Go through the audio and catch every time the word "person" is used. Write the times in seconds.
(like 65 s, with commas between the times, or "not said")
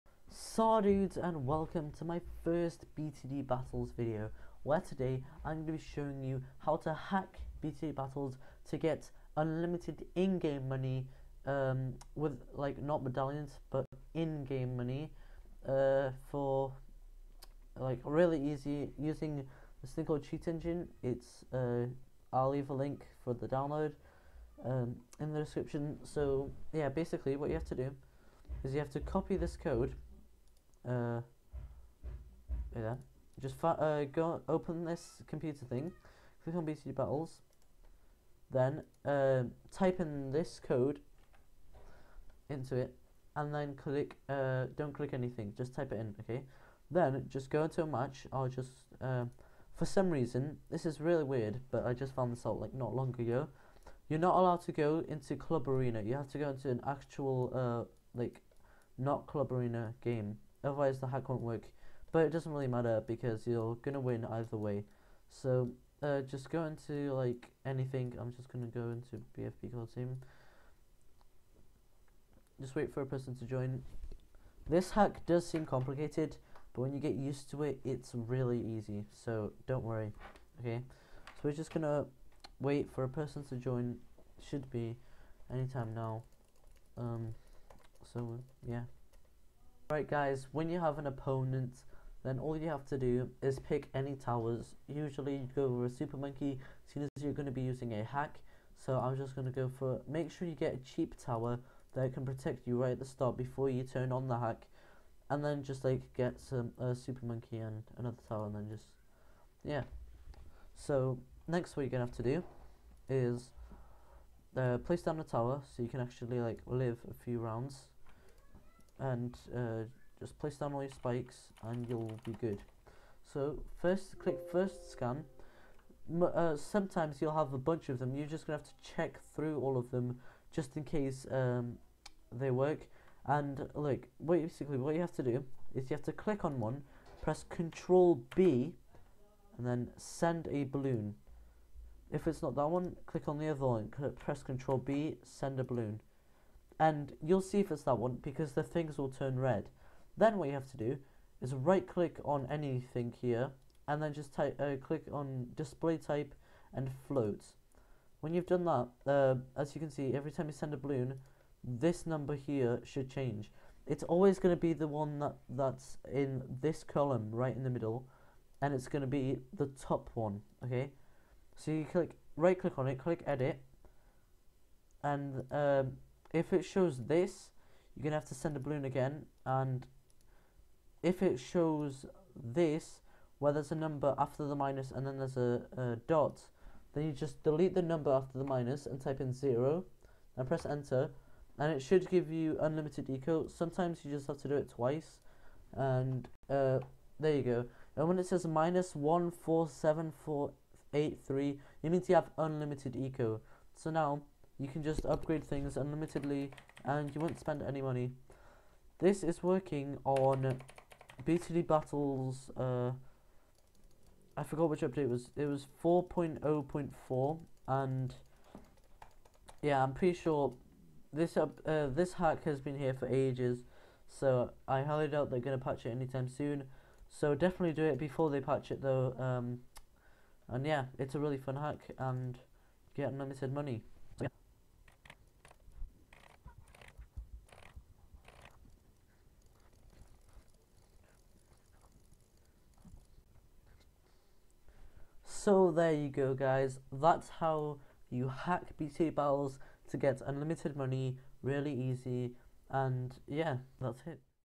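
73 s, 83 s.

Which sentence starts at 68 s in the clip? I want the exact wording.
I'm just gonna go into BFP call team.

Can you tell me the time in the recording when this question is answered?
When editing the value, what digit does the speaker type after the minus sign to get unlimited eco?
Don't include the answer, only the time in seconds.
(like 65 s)
189 s.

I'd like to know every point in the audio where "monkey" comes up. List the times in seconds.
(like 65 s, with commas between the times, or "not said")
96 s, 107 s.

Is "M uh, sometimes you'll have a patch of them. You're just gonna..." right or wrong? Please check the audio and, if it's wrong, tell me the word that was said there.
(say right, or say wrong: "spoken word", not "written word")
wrong: "bunch", not "patch".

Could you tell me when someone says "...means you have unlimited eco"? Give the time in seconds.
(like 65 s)
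201 s.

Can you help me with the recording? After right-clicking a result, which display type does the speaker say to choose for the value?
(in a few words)
float.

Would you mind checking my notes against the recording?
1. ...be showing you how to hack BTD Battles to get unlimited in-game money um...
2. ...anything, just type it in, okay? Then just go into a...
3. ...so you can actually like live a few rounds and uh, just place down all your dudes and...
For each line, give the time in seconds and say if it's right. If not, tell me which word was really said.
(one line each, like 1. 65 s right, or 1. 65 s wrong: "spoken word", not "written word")
1. 5 s right
2. 45 s right
3. 115 s wrong: "spikes", not "dudes".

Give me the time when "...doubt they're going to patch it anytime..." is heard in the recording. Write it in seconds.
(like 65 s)
225 s.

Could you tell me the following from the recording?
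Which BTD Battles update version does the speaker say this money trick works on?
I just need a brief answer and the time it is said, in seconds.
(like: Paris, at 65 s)
4.0.4, at 215 s.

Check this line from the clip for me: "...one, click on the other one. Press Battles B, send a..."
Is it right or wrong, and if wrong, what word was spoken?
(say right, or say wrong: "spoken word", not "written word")
wrong: "Control", not "Battles".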